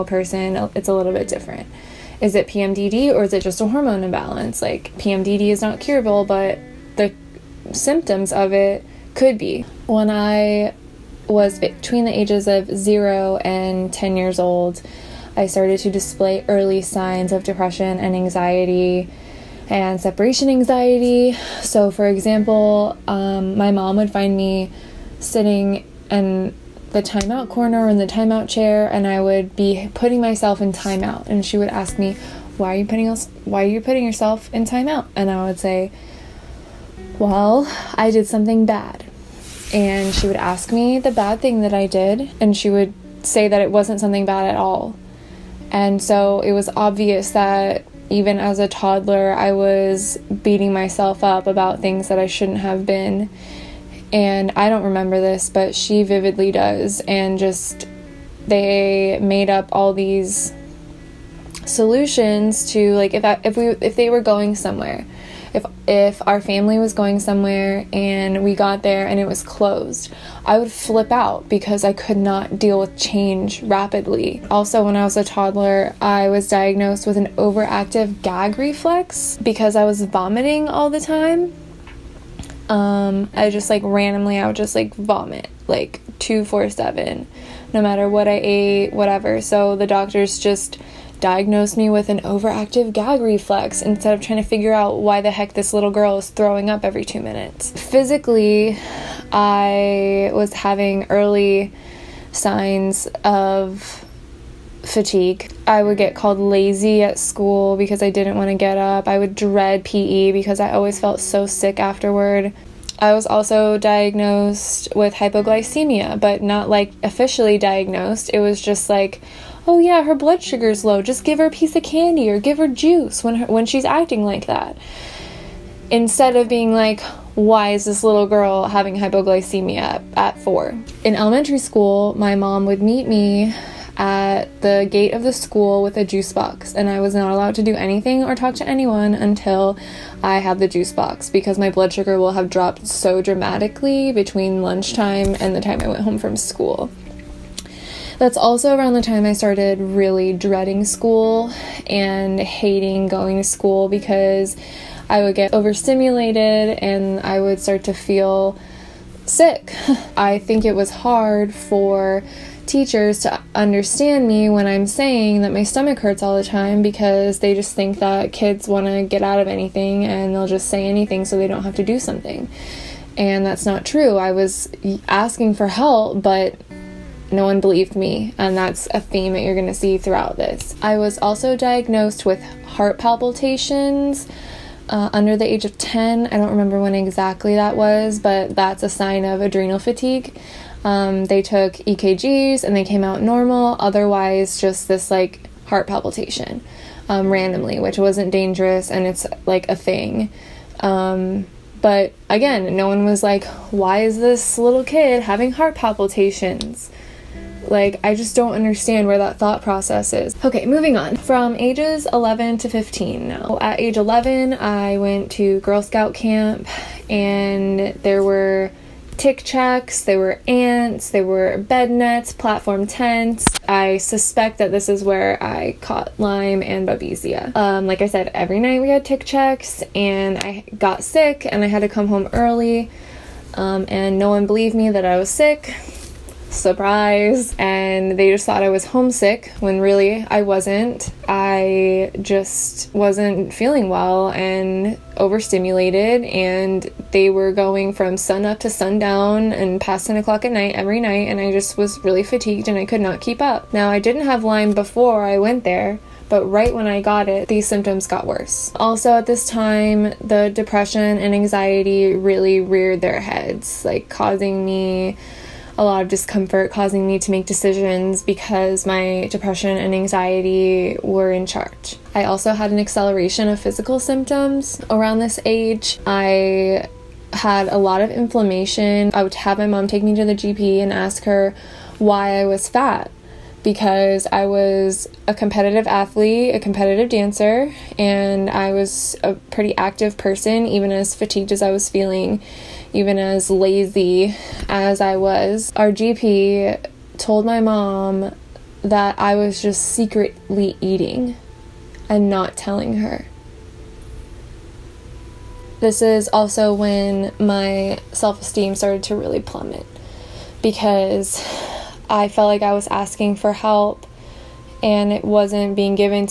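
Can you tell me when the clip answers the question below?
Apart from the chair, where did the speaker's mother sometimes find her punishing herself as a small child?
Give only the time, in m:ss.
0:27.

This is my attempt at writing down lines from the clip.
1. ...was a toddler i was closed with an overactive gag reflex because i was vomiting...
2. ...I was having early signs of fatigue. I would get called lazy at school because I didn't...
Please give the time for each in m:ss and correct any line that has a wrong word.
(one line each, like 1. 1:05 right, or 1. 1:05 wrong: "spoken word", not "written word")
1. 1:15 wrong: "diagnosed", not "closed"
2. 1:39 right.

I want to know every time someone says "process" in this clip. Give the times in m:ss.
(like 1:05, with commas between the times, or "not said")
3:29.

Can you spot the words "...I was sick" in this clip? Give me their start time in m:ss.
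3:55.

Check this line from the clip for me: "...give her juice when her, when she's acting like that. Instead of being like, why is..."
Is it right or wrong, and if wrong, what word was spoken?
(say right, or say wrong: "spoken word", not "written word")
right.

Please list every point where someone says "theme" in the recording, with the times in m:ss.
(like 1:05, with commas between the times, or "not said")
2:59.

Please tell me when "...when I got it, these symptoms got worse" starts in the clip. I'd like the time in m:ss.
4:16.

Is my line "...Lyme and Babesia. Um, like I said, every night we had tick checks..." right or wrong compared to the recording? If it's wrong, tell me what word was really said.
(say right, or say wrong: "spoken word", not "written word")
right.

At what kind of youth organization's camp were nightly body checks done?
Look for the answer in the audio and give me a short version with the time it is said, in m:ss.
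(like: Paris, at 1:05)
Girl Scout camp, at 3:35.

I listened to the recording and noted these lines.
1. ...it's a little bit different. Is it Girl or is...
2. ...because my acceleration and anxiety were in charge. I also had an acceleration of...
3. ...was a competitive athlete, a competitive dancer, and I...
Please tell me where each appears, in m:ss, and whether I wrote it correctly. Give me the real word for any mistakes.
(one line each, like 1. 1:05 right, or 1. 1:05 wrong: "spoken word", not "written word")
1. 0:00 wrong: "PMDD", not "Girl"
2. 4:28 wrong: "depression", not "acceleration"
3. 4:44 right.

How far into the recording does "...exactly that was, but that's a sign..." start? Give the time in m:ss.
3:06.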